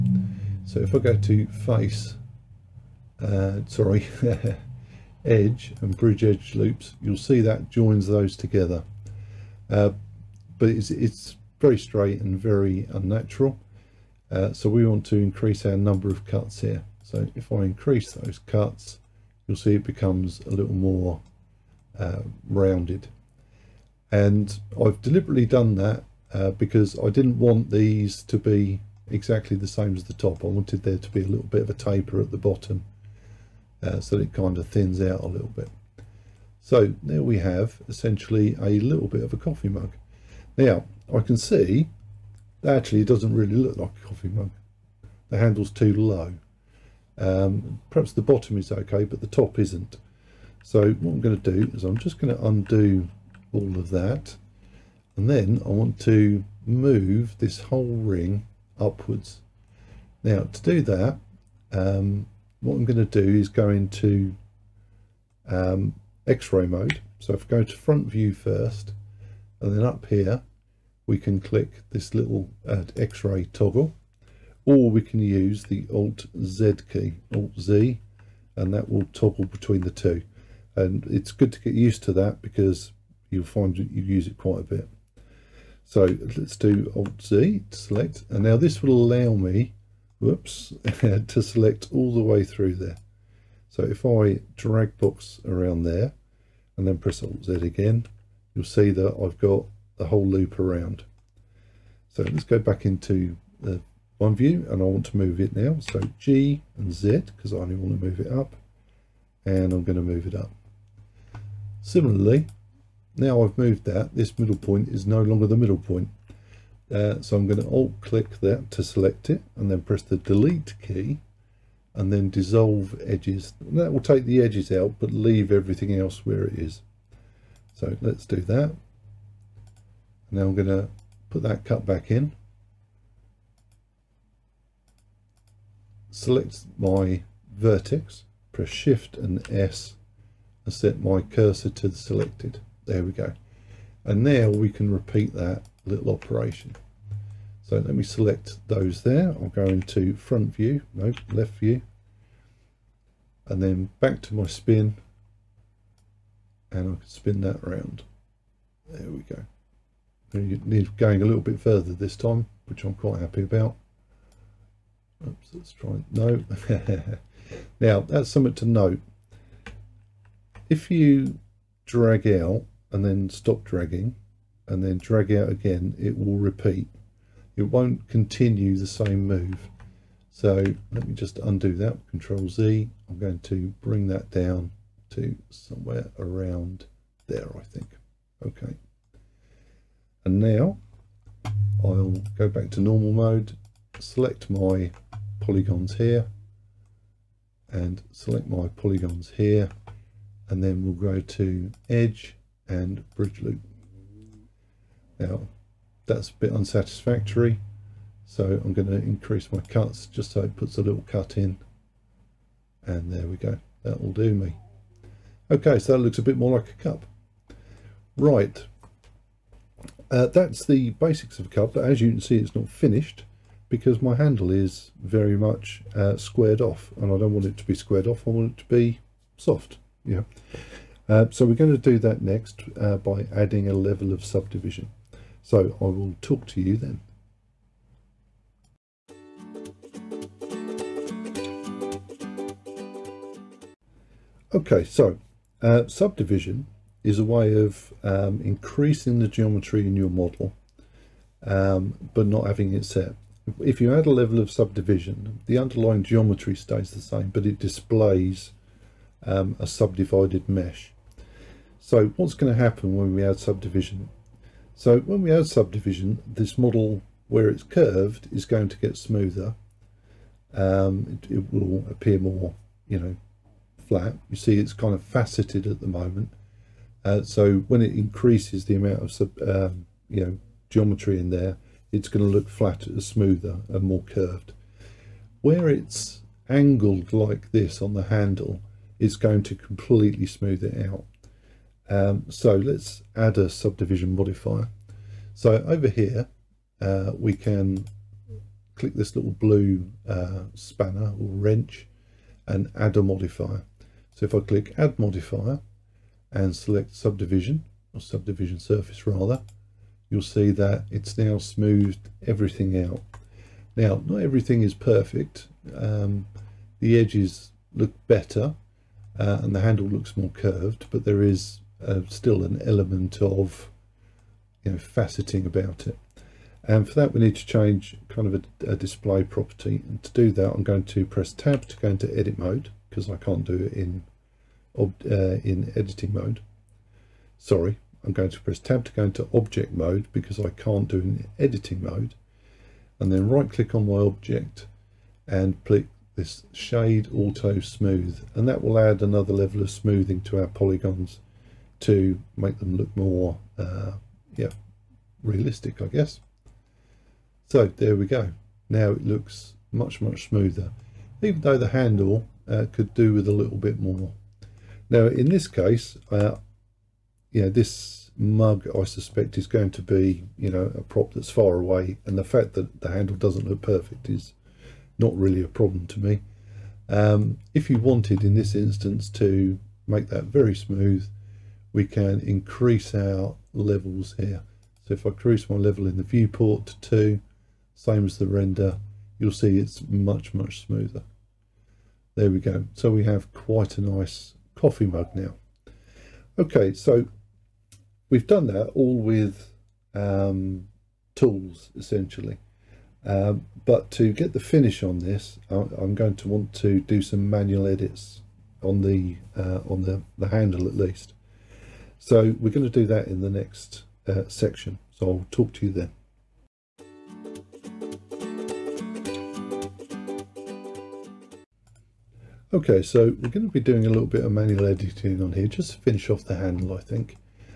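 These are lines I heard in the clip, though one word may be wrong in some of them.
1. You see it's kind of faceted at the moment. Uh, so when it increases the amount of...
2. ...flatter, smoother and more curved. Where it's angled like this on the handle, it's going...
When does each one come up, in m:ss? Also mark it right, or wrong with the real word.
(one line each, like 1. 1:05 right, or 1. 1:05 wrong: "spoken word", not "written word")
1. 4:34 right
2. 4:42 right.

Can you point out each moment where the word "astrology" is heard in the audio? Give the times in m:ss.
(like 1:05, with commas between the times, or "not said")
not said.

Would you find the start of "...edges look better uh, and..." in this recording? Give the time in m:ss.
5:16.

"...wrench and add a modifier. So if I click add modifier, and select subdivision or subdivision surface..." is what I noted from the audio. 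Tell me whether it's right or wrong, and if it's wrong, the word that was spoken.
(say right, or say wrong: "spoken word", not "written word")
right.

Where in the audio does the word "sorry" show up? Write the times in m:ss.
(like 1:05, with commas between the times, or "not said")
0:03, 5:37.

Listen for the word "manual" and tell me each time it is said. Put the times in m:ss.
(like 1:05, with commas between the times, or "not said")
6:47, 7:04.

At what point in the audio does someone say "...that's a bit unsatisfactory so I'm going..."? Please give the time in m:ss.
3:26.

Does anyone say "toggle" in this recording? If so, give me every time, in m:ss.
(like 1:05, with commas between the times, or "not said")
1:13, 1:19.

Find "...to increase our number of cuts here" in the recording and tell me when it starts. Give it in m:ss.
0:15.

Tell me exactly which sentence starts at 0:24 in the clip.
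And I've deliberately done that uh, because I didn't want these to be exactly the same as the top.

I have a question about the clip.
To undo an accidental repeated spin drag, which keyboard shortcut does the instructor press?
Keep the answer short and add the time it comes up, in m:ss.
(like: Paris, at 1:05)
Control Z, at 3:02.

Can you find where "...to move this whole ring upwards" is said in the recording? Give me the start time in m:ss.
0:55.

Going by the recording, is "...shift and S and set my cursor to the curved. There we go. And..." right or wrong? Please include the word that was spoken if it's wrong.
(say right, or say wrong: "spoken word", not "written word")
wrong: "selected", not "curved".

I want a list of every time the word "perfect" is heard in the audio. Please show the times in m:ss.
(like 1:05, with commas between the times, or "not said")
5:14, 6:13.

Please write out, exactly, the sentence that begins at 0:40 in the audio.
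Now, I can see that actually it doesn't really look like a coffee mug.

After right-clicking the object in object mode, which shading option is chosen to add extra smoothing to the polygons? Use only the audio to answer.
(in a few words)
Shade Auto Smooth.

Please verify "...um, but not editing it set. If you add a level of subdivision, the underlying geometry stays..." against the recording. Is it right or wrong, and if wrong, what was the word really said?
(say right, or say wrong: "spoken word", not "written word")
wrong: "having", not "editing".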